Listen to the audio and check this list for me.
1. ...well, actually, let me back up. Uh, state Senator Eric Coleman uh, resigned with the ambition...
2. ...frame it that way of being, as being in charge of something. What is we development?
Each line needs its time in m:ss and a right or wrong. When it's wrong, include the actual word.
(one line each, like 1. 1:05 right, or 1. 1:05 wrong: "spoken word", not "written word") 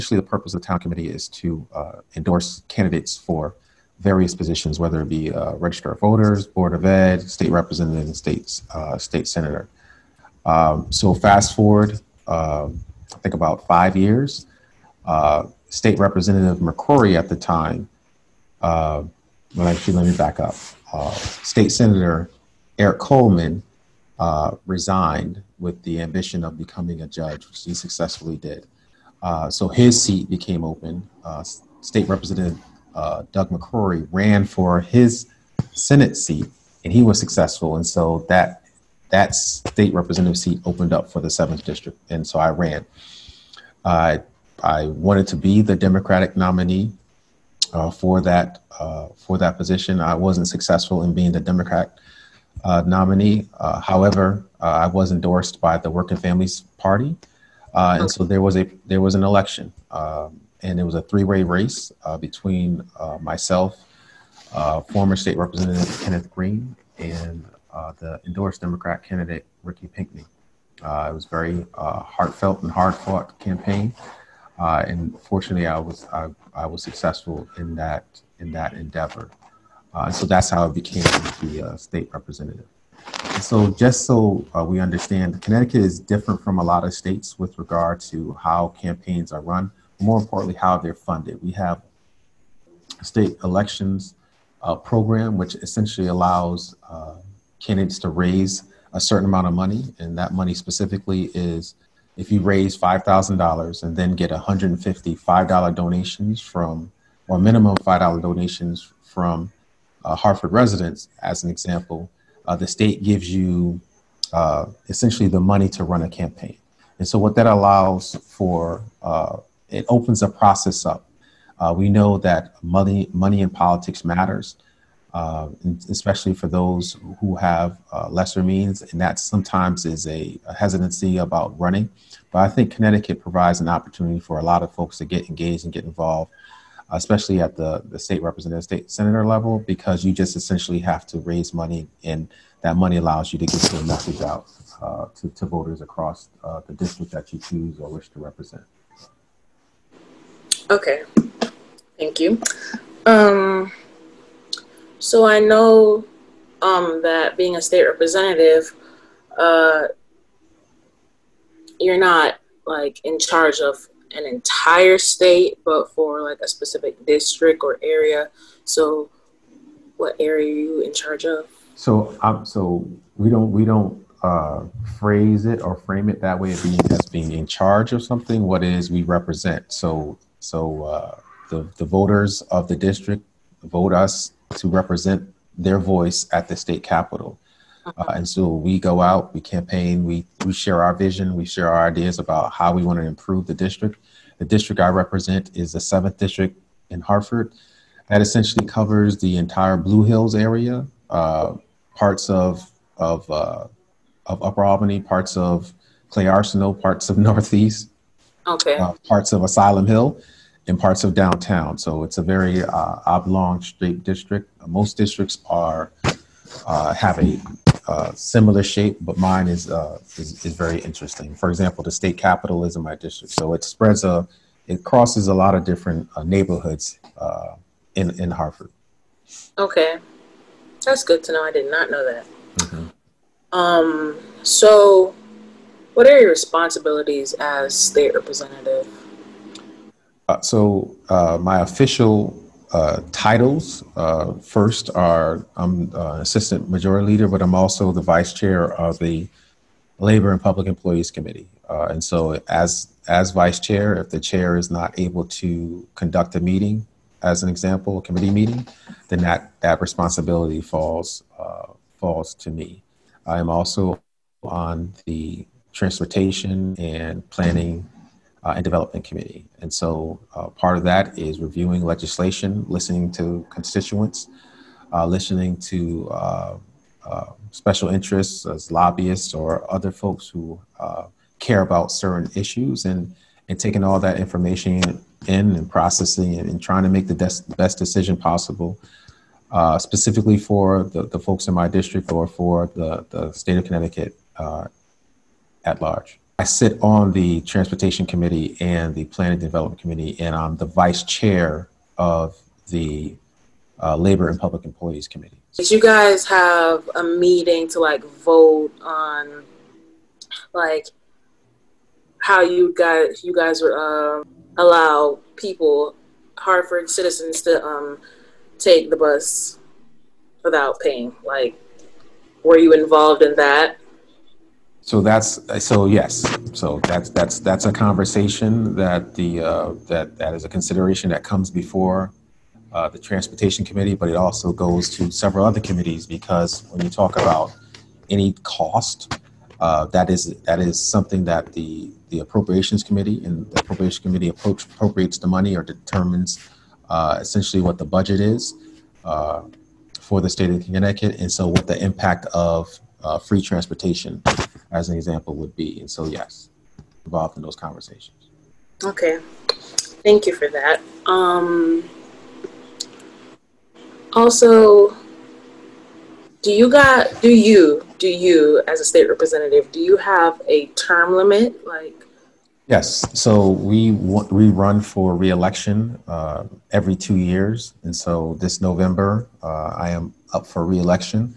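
1. 0:19 right
2. 2:55 wrong: "represent", not "development".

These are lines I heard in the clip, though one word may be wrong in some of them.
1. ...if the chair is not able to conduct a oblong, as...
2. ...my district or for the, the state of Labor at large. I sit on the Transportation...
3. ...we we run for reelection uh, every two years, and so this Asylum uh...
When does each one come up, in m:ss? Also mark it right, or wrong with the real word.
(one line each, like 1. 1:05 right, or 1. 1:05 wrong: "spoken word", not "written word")
1. 4:13 wrong: "meeting", not "oblong"
2. 4:51 wrong: "Connecticut", not "Labor"
3. 6:13 wrong: "November", not "Asylum".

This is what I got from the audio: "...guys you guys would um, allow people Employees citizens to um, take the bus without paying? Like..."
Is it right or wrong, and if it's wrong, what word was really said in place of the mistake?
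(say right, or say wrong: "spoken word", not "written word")
wrong: "Hartford", not "Employees".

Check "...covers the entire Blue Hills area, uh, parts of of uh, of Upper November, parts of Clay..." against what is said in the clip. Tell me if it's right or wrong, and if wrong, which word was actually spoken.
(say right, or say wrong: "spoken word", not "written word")
wrong: "Albany", not "November".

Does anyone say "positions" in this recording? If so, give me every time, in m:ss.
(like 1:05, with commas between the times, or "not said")
0:04, 0:49.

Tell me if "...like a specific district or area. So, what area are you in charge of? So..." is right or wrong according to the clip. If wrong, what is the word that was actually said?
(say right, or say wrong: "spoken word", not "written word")
right.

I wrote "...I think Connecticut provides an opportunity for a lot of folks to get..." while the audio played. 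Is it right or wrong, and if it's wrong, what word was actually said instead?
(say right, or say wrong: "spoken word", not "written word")
right.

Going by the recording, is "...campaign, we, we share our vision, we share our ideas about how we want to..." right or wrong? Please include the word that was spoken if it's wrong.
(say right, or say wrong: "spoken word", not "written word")
right.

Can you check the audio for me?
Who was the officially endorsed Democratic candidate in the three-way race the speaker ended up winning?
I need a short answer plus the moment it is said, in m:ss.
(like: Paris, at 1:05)
Ricky Pinkney, at 1:09.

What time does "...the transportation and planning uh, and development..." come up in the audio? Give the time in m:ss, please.
4:25.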